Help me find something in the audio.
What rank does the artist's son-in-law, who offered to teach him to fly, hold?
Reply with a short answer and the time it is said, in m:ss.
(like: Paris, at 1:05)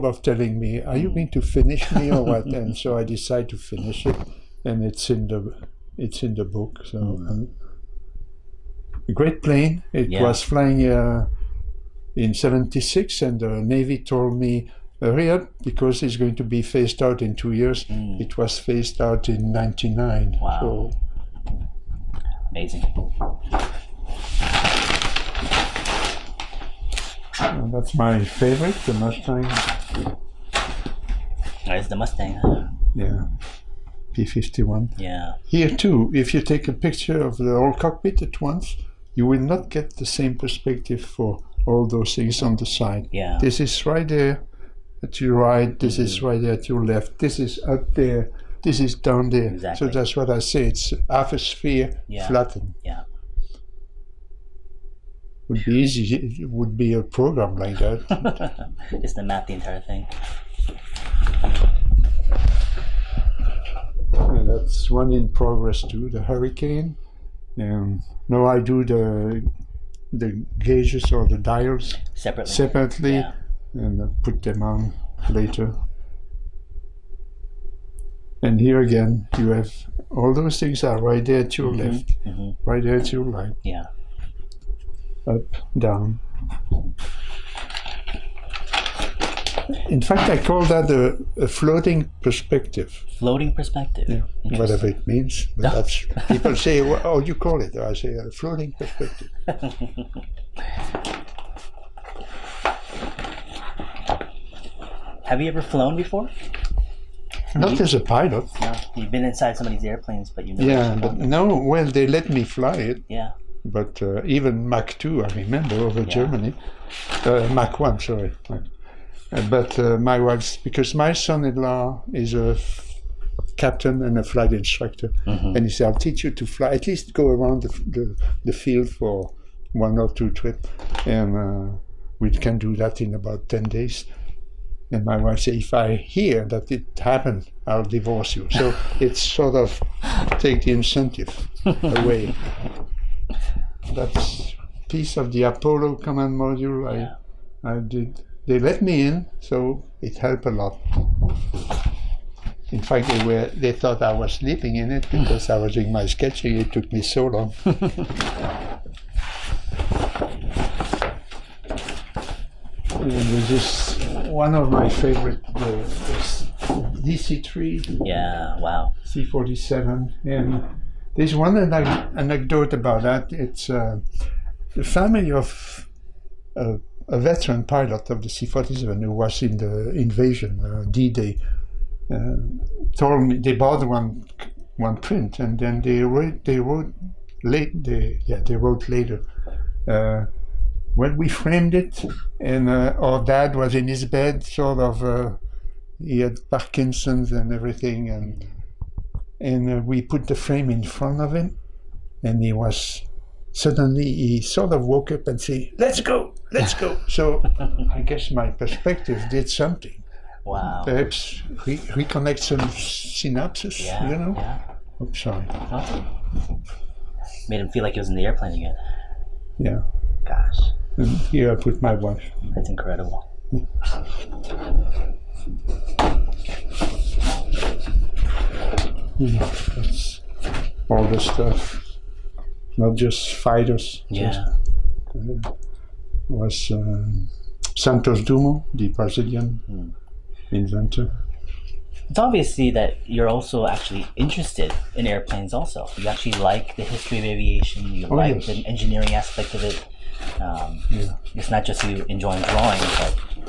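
captain, at 2:03.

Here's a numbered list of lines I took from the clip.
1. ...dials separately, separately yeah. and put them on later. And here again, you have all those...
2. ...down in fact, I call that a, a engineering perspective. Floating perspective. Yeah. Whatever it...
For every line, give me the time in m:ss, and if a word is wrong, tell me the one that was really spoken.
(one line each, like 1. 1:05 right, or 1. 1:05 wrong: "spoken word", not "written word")
1. 1:11 right
2. 1:25 wrong: "floating", not "engineering".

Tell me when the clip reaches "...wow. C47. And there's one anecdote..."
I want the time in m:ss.
2:48.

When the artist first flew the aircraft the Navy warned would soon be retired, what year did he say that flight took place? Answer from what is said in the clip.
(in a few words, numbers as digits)
1976.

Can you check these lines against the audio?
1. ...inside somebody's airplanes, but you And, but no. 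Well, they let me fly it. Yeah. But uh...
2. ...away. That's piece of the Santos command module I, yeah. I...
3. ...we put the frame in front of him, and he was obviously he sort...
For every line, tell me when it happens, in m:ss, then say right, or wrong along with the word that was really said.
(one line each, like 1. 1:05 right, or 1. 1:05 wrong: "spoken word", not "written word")
1. 1:49 wrong: "Yeah", not "And"
2. 2:21 wrong: "Apollo", not "Santos"
3. 3:19 wrong: "suddenly", not "obviously".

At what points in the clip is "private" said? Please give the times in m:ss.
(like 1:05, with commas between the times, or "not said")
not said.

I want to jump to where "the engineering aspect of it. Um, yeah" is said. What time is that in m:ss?
4:08.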